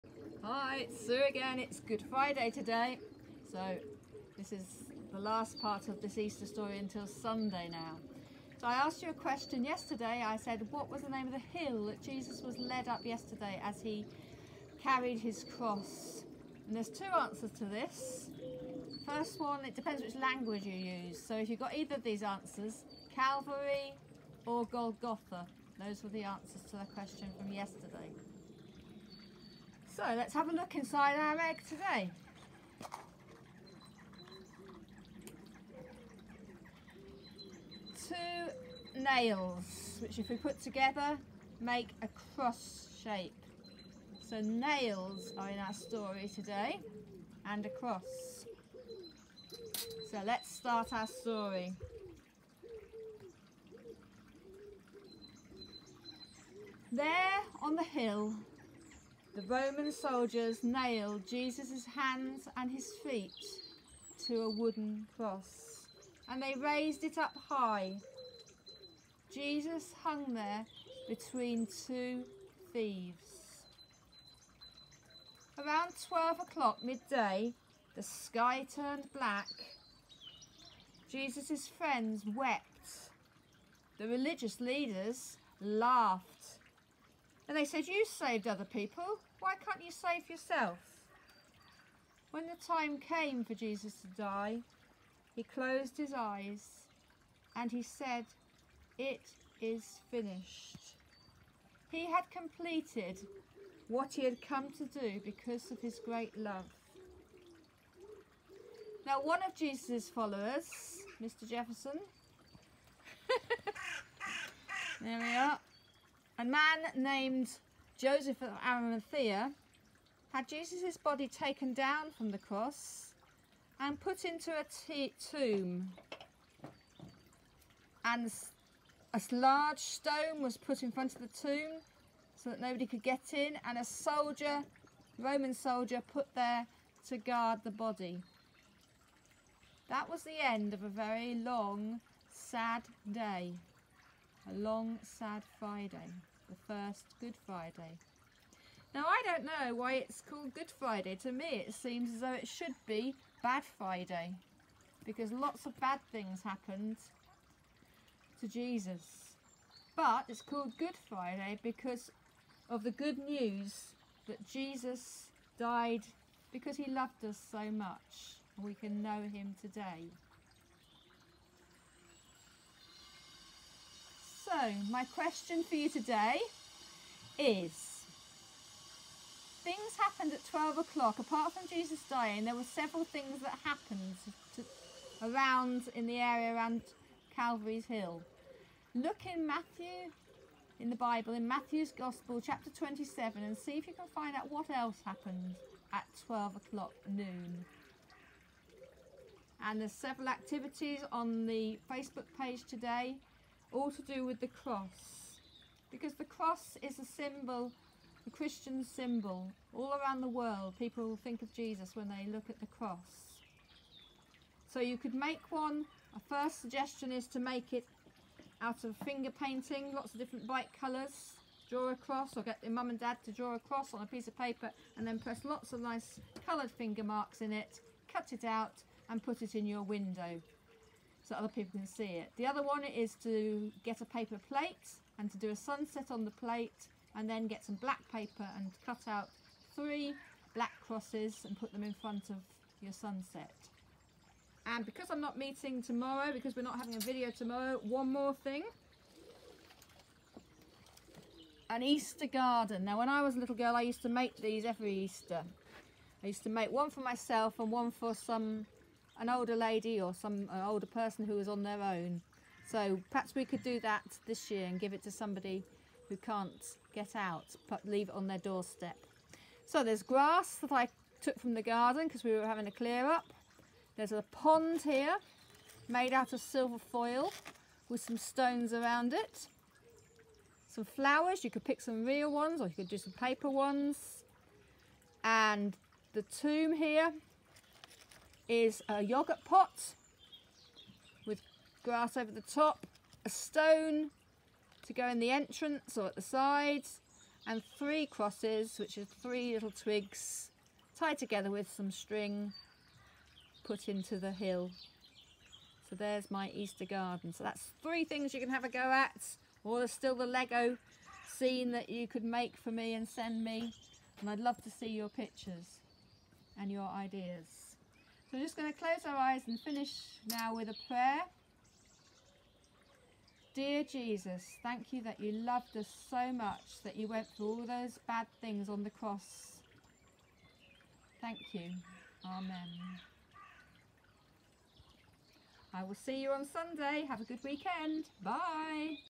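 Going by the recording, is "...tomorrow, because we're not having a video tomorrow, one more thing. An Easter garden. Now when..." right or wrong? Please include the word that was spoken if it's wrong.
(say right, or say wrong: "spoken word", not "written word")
right.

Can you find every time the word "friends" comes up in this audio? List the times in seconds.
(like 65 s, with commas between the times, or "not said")
81 s.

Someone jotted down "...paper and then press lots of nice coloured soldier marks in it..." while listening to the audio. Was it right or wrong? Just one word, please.
wrong.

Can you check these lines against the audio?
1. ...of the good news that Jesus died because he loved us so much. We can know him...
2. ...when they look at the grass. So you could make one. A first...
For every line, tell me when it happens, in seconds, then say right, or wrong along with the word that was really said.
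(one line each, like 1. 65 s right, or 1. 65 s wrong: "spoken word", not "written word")
1. 162 s right
2. 211 s wrong: "cross", not "grass".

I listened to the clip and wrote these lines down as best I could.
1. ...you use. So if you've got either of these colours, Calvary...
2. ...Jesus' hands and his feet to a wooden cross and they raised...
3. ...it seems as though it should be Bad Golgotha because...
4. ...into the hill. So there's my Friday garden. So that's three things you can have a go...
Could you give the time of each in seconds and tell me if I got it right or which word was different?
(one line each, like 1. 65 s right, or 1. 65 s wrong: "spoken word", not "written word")
1. 20 s wrong: "answers", not "colours"
2. 61 s right
3. 151 s wrong: "Friday", not "Golgotha"
4. 303 s wrong: "Easter", not "Friday".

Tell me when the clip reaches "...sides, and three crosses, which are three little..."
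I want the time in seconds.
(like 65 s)
296 s.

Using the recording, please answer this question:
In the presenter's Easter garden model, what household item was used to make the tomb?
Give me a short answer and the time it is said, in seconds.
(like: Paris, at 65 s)
A yogurt pot, at 289 s.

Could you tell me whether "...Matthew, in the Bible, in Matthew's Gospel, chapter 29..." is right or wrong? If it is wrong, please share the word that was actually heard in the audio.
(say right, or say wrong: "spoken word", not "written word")
wrong: "27", not "29".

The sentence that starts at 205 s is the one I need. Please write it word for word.
Because the cross is a symbol, a Christian symbol.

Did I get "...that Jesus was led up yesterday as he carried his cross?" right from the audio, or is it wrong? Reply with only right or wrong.
right.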